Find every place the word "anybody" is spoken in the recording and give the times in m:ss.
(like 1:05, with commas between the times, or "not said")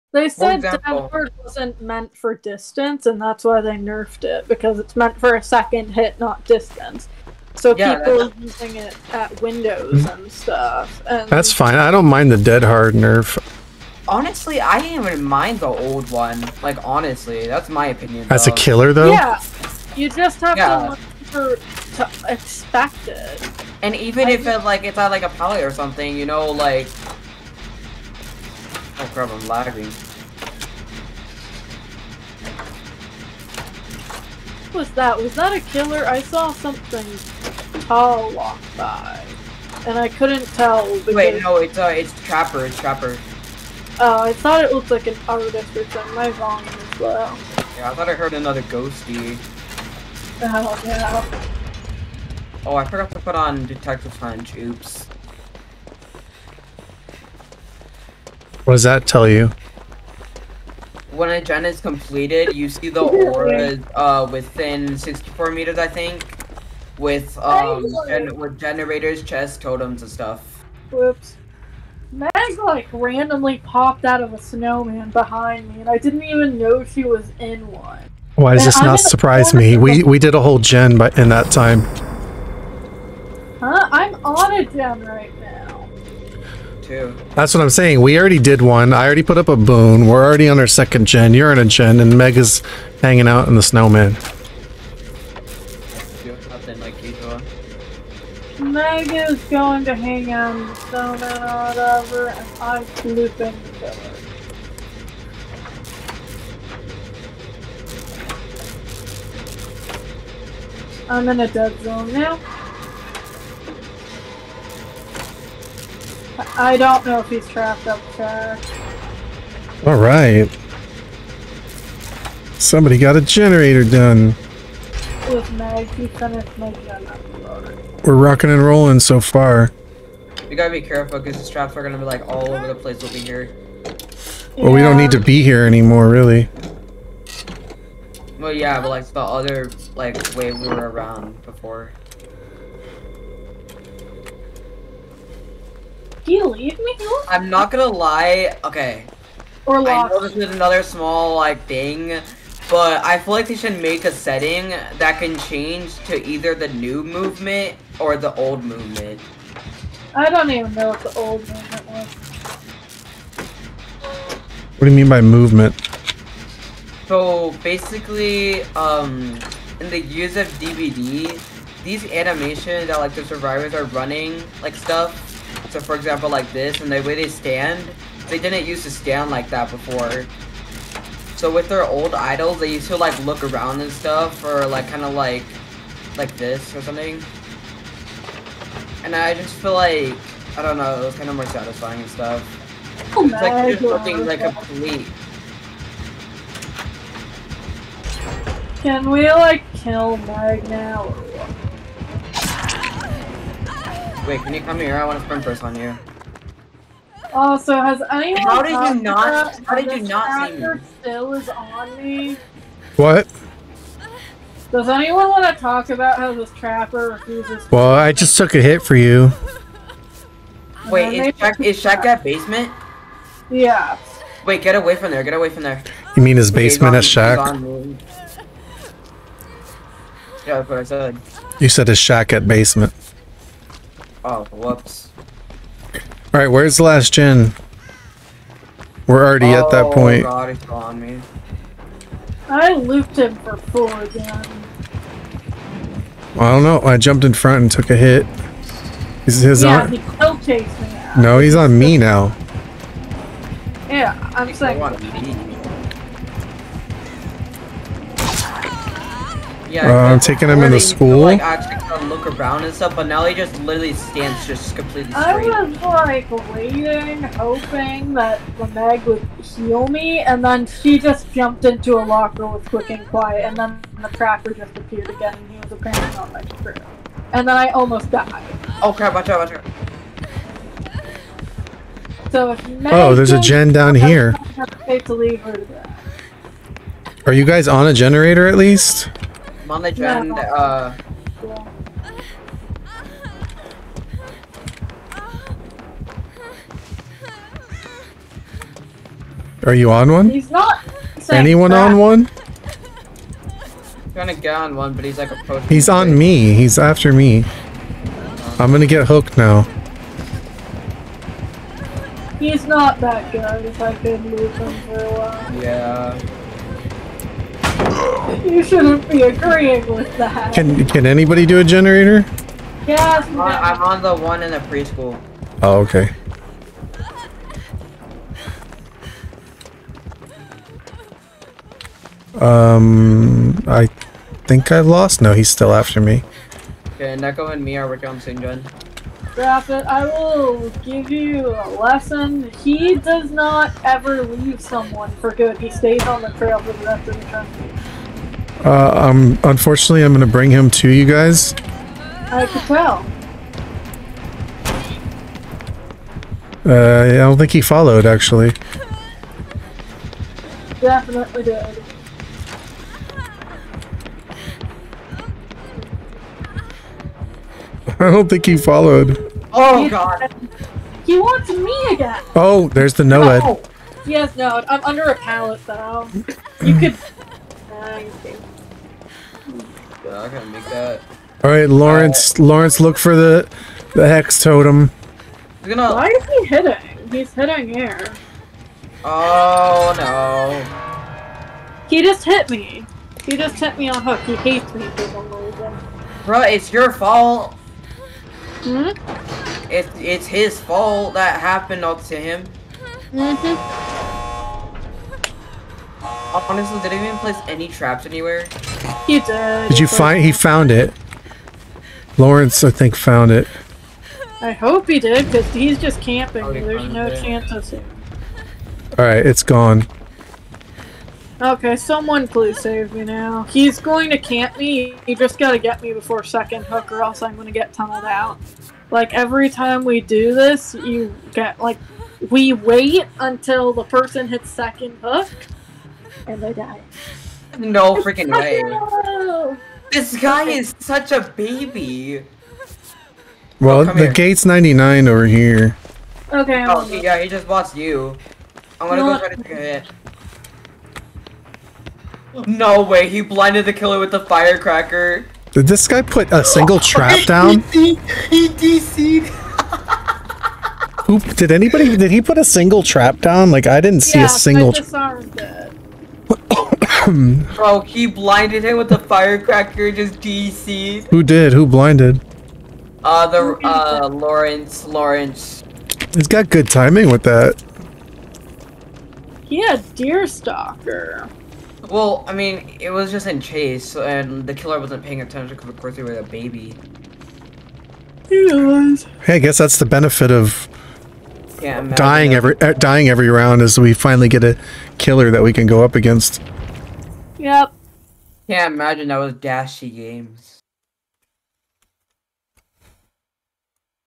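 5:21, 7:41.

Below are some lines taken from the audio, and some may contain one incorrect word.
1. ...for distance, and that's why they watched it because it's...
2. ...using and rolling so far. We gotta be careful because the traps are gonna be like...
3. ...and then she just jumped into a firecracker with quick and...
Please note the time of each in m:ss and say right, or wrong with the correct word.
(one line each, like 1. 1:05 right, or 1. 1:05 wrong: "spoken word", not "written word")
1. 0:02 wrong: "nerfed", not "watched"
2. 2:08 wrong: "rocking", not "using"
3. 4:30 wrong: "locker", not "firecracker".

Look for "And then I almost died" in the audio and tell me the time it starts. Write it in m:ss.
4:37.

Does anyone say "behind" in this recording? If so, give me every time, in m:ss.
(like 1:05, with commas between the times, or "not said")
1:15.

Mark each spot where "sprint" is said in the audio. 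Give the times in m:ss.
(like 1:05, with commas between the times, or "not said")
3:25.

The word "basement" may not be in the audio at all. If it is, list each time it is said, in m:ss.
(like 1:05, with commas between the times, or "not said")
3:42, 3:46, 3:52.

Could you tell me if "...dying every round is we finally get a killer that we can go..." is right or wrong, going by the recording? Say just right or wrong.
right.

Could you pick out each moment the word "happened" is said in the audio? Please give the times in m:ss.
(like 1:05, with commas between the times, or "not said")
6:41.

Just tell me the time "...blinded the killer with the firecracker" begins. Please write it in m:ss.
7:33.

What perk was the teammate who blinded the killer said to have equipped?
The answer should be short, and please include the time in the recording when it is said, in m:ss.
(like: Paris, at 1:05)
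Deerstalker, at 7:59.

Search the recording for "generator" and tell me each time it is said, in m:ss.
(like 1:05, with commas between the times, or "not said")
1:08, 2:03, 4:47, 5:21.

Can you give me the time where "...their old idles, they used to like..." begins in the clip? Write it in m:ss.
3:01.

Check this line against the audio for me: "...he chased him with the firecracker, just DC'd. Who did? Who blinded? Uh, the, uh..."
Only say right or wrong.
wrong.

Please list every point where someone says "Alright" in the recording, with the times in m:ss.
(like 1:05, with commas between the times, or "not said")
3:56, 6:58.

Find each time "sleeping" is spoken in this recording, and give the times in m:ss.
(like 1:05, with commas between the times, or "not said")
1:42.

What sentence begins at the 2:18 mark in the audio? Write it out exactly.
Well, yeah, but like the other like way we were around before.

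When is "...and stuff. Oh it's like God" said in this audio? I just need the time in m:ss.
3:12.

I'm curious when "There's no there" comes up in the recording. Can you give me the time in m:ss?
6:56.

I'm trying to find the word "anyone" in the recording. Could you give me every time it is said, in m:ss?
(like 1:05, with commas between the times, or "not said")
3:28, 3:34, 5:01.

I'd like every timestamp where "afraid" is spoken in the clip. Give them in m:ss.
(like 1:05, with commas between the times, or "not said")
not said.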